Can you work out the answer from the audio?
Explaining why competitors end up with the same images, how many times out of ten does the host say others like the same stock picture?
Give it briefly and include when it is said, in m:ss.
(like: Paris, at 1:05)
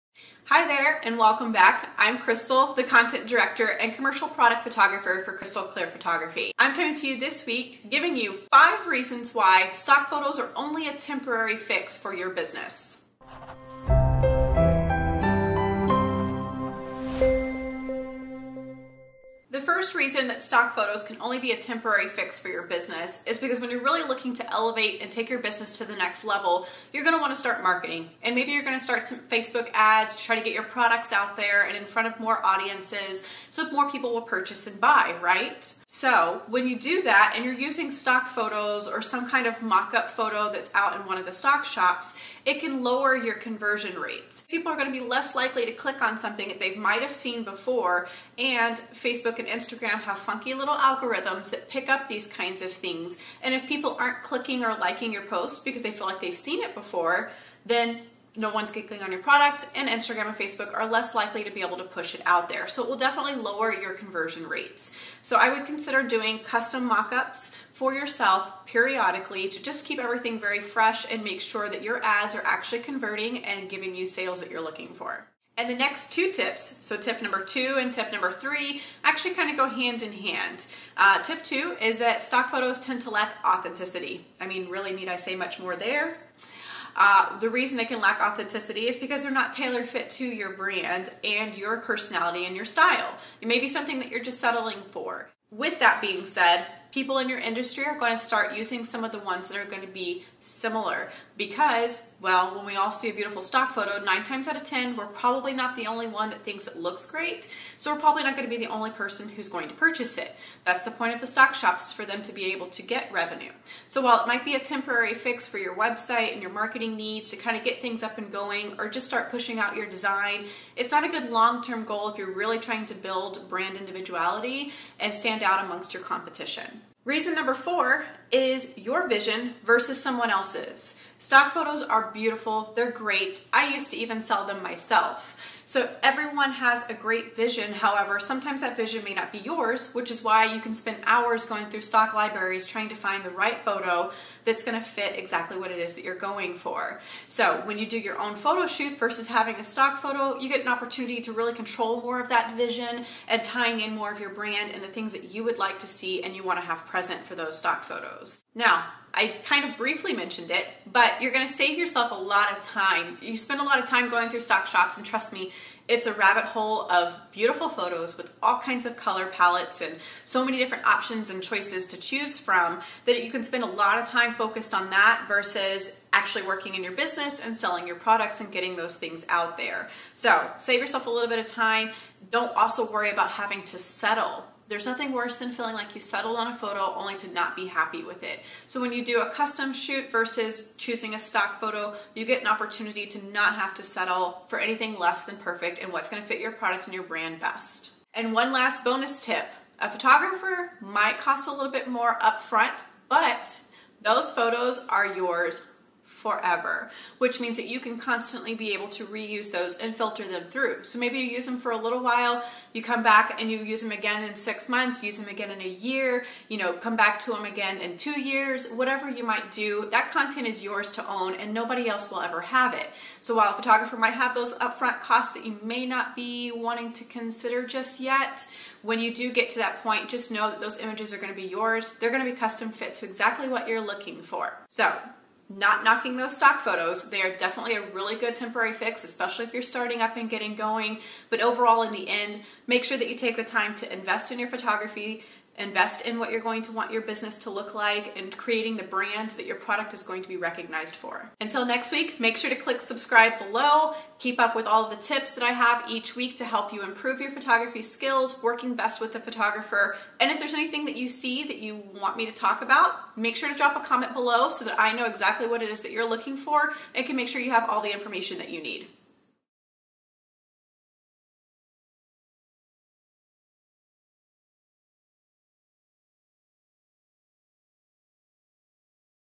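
9, at 1:44.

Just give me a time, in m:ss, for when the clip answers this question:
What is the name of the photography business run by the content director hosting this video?
0:05.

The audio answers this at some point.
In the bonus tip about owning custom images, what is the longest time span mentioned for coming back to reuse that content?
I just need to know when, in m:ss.
3:37.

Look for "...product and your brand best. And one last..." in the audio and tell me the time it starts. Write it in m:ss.
3:16.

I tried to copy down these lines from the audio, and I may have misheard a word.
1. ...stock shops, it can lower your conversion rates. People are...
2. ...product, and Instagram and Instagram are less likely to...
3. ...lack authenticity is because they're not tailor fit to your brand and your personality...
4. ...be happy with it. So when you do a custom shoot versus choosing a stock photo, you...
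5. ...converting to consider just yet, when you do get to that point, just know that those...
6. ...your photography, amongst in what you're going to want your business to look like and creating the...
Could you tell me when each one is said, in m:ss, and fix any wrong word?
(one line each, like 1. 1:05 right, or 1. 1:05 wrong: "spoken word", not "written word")
1. 0:41 right
2. 0:59 wrong: "Facebook", not "Instagram"
3. 1:28 right
4. 3:07 right
5. 3:46 wrong: "wanting", not "converting"
6. 4:04 wrong: "invest", not "amongst".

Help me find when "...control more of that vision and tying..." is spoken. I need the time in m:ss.
2:31.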